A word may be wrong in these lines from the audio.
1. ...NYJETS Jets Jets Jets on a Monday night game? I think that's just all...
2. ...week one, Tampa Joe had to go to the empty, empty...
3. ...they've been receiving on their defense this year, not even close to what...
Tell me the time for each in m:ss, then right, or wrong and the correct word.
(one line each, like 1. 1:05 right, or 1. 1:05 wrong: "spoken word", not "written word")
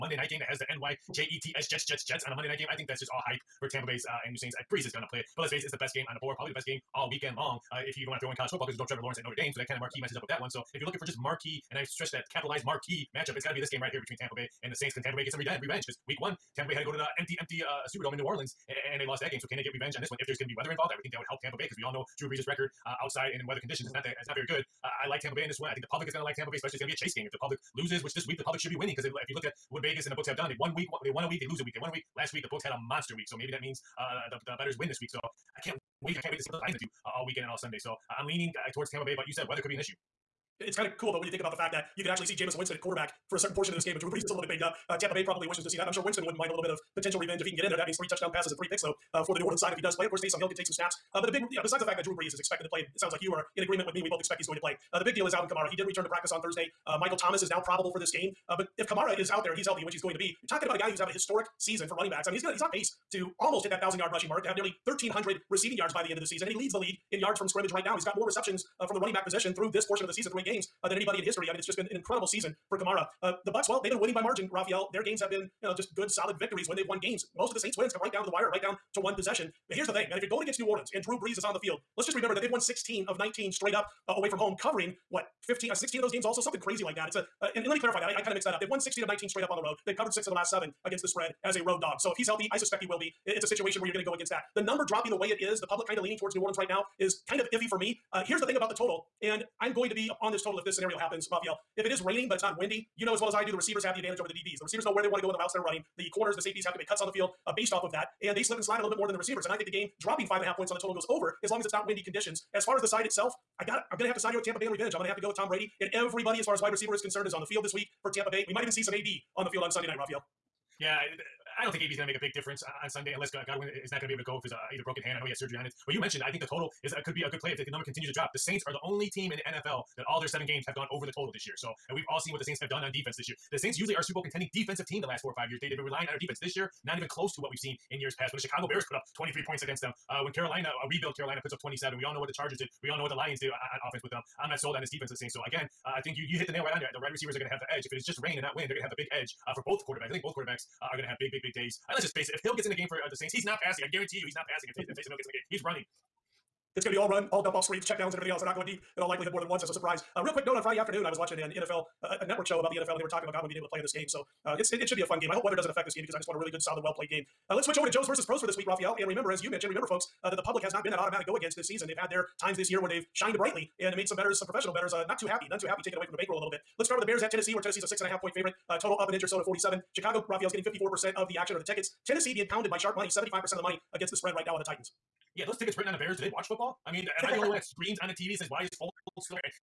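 1. 0:00 right
2. 0:16 wrong: "Bay", not "Joe"
3. 2:15 wrong: "relying", not "receiving".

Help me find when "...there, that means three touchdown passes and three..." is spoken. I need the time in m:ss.
0:47.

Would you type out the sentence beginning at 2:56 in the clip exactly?
Let's start with the Bears at Tennessee, where Tennessee's a six and a half point favorite.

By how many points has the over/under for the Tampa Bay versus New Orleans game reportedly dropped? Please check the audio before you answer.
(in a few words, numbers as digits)
5.5.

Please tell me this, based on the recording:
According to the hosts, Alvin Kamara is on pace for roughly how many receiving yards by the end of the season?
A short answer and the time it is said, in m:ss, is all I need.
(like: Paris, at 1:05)
1,300, at 1:04.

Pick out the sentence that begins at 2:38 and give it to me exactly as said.
They're not going deep in all likelihood more than once as a surprise.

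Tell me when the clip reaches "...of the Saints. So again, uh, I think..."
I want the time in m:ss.
2:25.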